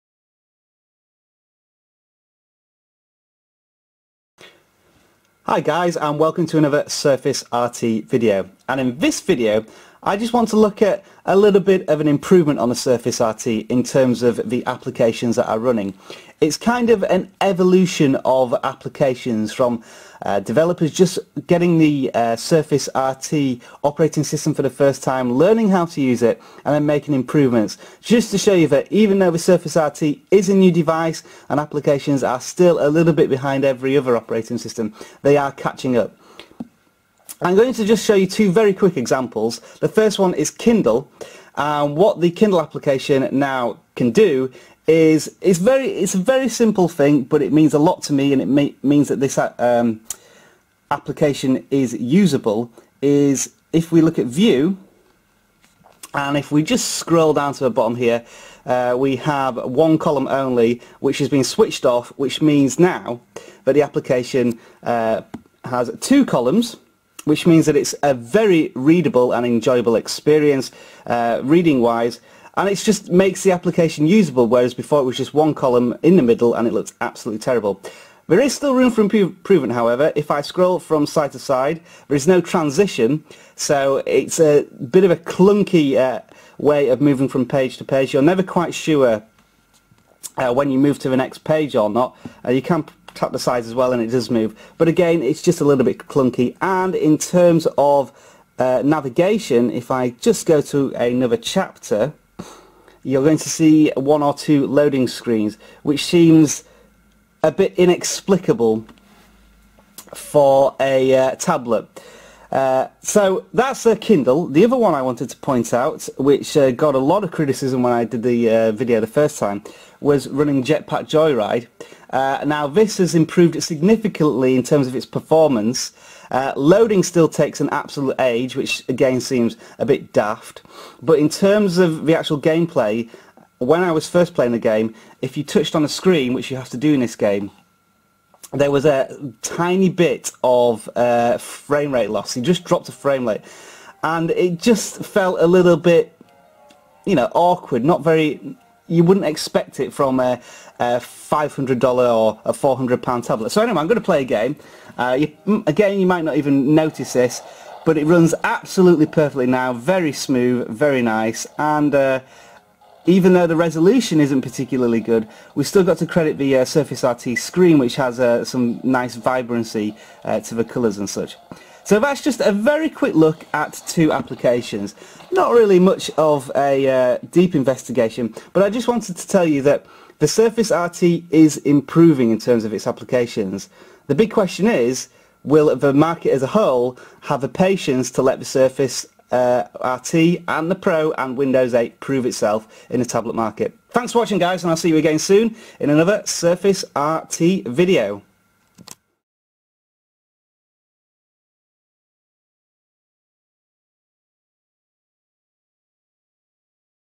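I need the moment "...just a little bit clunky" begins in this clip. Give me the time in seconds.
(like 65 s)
95 s.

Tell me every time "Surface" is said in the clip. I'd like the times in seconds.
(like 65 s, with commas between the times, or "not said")
6 s, 12 s, 22 s, 29 s, 166 s, 180 s, 188 s, 196 s.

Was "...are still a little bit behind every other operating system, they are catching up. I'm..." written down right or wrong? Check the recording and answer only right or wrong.
right.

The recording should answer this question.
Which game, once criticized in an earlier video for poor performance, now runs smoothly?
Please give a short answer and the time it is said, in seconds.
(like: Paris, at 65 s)
Jetpack Joyride, at 120 s.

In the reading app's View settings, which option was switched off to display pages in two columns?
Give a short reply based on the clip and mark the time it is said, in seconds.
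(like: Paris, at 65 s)
one column only, at 59 s.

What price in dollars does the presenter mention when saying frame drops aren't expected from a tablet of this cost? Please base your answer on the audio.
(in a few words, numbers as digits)
$500.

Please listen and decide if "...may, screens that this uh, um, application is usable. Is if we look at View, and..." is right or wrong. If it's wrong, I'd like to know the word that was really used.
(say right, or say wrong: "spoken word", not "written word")
wrong: "means", not "screens".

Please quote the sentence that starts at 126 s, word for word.
Uh, loading still takes an absolute age, which again seems a bit daft.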